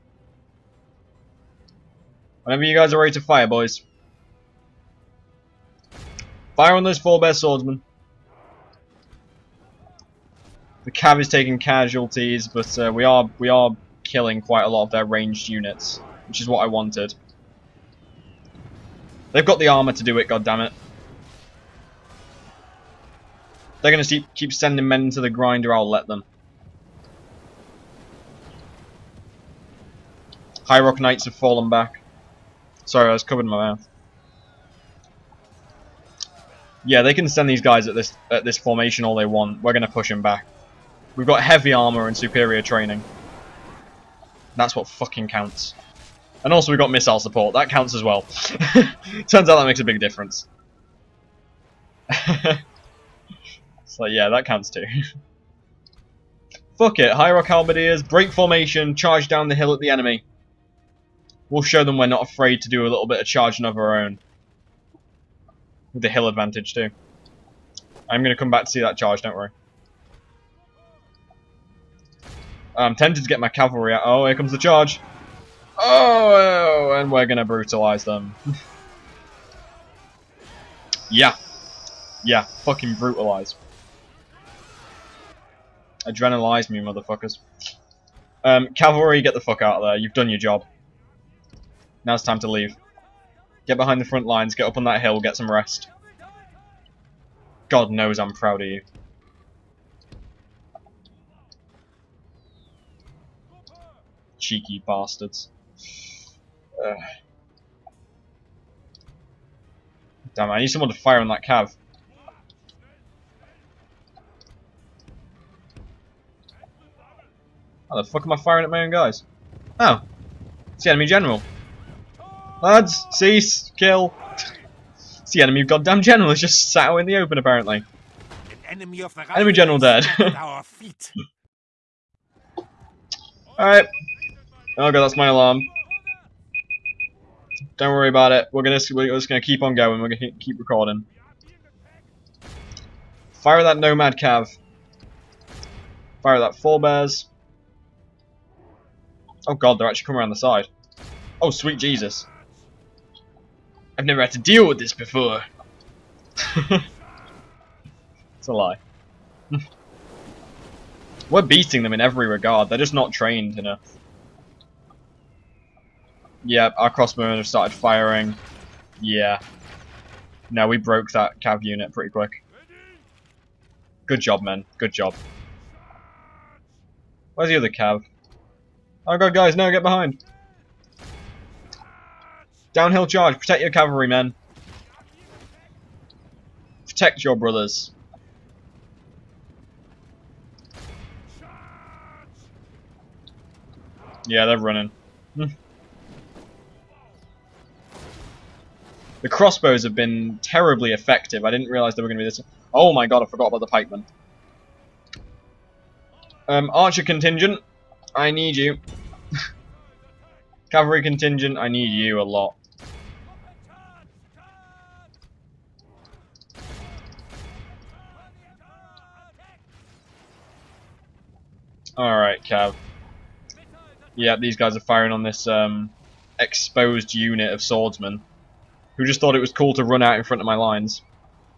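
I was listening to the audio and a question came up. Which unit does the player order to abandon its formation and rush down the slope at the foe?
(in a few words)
High Halberdiers.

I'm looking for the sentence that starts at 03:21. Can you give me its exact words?
I didn't realize they were going to be this...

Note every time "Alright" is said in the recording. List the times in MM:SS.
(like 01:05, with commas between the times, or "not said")
02:13, 03:41.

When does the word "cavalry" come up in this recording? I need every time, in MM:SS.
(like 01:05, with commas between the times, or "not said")
01:13, 01:28, 03:03, 03:30.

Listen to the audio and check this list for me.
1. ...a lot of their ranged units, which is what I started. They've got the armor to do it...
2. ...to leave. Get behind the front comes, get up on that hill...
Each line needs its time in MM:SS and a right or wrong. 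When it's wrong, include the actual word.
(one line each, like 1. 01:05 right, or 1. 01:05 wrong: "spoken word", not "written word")
1. 00:14 wrong: "wanted", not "started"
2. 01:32 wrong: "lines", not "comes".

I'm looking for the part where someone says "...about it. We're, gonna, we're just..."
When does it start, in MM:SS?
02:18.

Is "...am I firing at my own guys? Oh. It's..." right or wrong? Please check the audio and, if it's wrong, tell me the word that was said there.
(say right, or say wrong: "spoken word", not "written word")
right.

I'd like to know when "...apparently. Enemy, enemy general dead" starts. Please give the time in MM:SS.
02:07.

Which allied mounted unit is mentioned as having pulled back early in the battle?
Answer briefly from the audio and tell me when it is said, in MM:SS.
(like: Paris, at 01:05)
High Rock Knights, at 00:30.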